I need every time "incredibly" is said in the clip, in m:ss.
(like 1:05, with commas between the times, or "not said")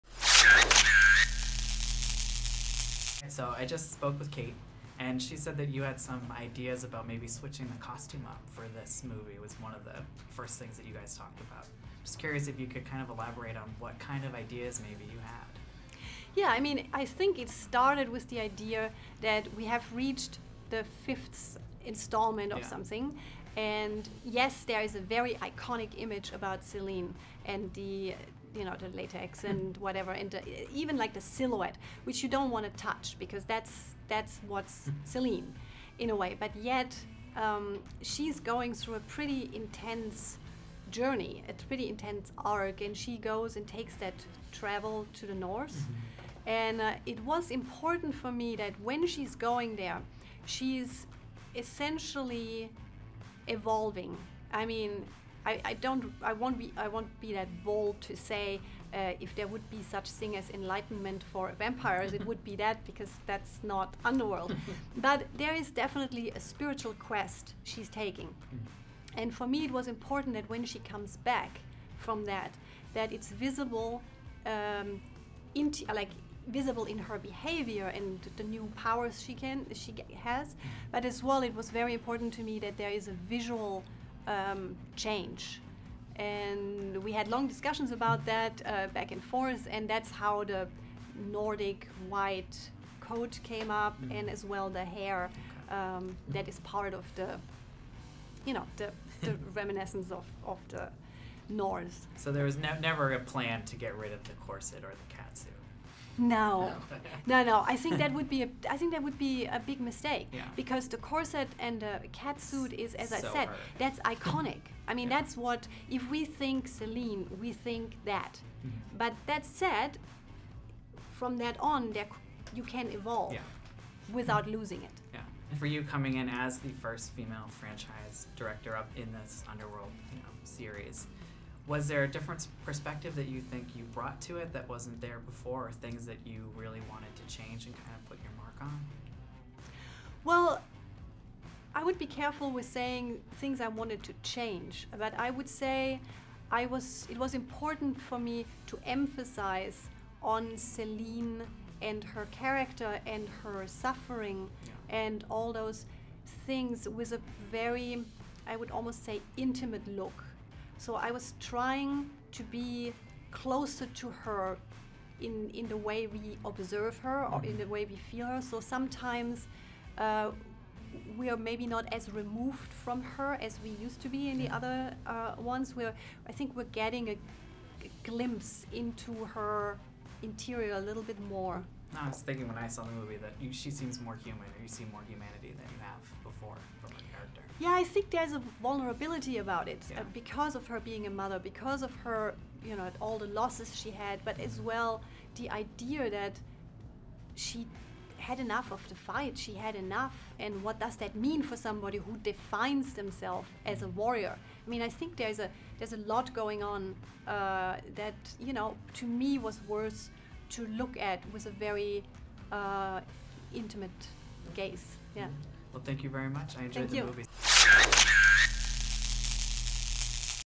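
not said.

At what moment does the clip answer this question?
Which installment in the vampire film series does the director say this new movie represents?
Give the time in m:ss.
0:21.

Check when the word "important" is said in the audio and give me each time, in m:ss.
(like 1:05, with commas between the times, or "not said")
0:47, 1:09, 1:21, 2:27.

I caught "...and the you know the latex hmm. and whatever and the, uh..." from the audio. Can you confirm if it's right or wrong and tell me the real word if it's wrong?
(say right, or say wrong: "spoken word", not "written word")
right.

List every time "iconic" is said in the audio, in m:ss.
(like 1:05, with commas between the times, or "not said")
0:25, 1:53.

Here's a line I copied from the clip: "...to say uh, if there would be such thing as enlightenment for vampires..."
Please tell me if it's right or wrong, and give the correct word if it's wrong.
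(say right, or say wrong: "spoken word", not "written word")
right.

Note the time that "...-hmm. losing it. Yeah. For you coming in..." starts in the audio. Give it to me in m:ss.
2:04.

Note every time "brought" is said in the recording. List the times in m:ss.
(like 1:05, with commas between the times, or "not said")
2:13.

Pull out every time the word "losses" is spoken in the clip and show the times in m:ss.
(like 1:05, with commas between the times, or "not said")
3:13.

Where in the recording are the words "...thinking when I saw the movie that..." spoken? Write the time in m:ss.
3:02.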